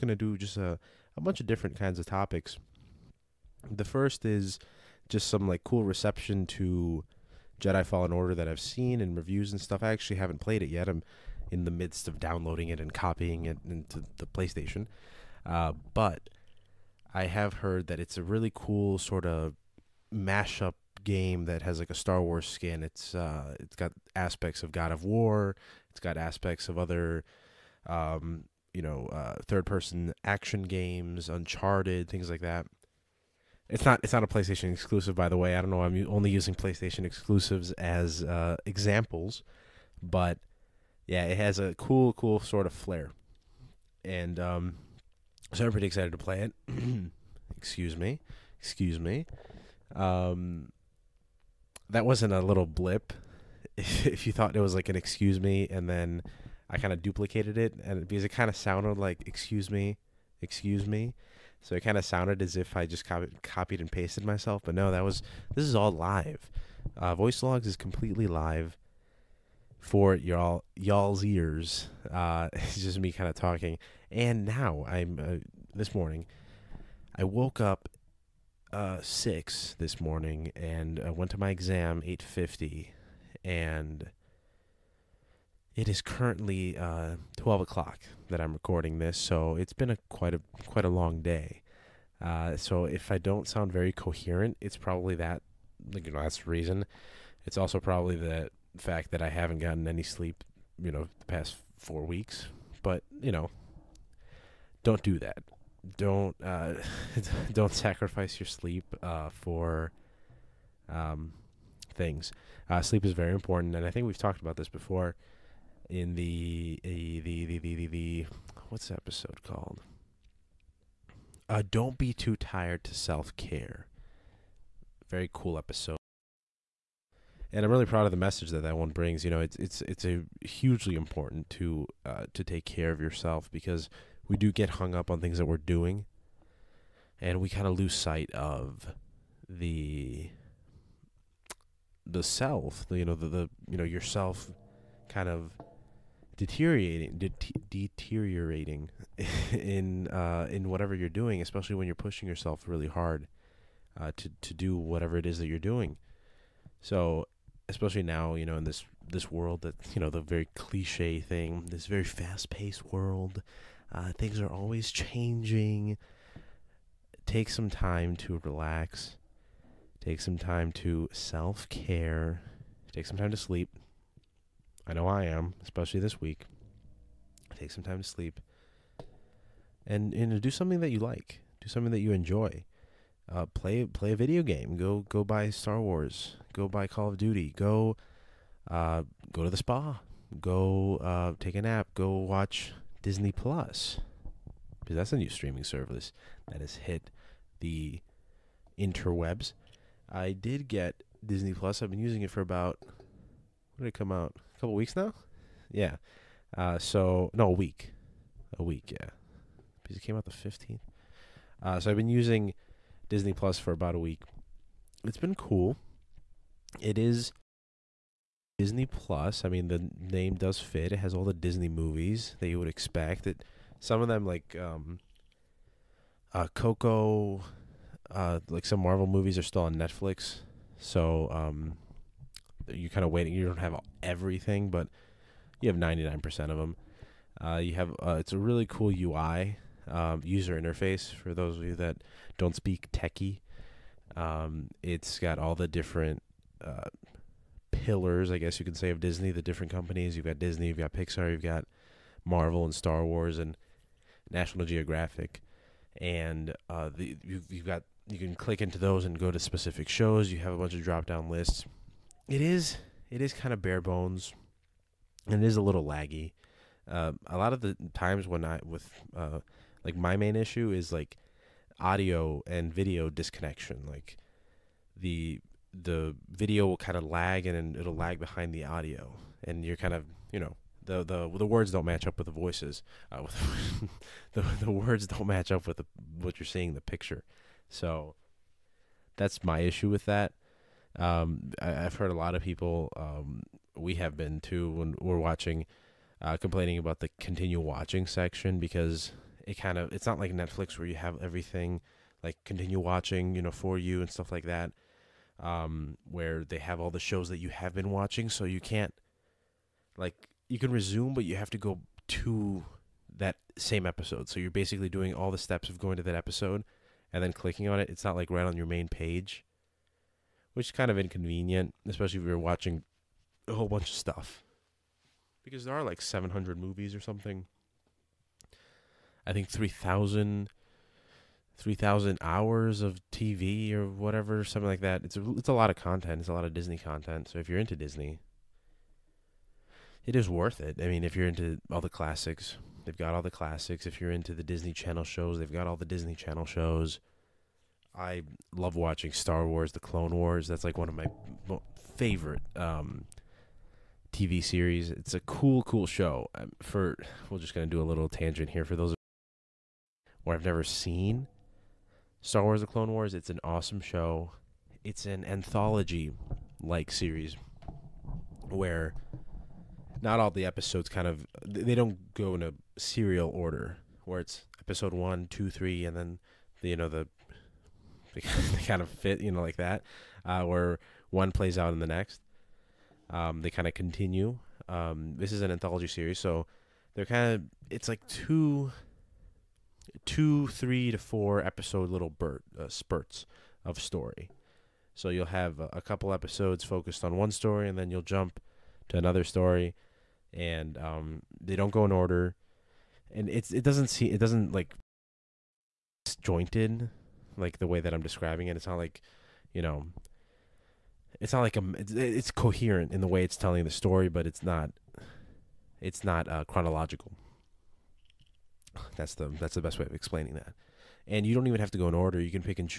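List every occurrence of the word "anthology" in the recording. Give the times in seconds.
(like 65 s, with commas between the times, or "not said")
365 s, 385 s.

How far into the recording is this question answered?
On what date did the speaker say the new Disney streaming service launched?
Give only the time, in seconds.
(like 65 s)
210 s.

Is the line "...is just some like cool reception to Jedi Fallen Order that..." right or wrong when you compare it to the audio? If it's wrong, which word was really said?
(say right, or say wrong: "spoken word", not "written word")
right.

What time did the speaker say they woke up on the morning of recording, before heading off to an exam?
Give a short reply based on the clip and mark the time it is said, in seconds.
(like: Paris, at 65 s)
6, at 79 s.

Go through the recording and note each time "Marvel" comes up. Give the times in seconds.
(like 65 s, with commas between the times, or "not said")
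228 s, 252 s.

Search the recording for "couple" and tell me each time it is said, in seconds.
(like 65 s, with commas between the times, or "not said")
204 s, 395 s.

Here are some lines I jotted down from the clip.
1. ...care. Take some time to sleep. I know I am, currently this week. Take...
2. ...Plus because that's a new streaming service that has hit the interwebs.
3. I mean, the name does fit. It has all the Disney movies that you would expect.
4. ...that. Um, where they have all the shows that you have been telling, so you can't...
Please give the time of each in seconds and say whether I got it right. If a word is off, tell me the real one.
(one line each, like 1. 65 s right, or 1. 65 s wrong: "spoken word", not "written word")
1. 171 s wrong: "especially", not "currently"
2. 193 s right
3. 219 s right
4. 304 s wrong: "watching", not "telling".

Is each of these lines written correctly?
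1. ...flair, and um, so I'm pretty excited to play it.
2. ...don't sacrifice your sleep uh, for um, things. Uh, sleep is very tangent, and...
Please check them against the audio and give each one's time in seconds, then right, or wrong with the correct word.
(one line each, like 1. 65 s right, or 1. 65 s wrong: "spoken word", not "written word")
1. 42 s right
2. 107 s wrong: "important", not "tangent".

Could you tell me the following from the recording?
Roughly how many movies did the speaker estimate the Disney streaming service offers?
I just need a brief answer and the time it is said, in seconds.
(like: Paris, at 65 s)
700, at 325 s.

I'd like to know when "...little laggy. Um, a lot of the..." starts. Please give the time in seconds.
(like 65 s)
265 s.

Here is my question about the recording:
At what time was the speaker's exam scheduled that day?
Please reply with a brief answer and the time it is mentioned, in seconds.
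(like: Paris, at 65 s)
8:50, at 82 s.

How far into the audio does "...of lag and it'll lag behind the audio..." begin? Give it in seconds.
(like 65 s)
276 s.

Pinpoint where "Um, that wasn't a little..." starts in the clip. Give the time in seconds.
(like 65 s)
49 s.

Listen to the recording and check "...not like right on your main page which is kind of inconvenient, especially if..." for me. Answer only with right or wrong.
right.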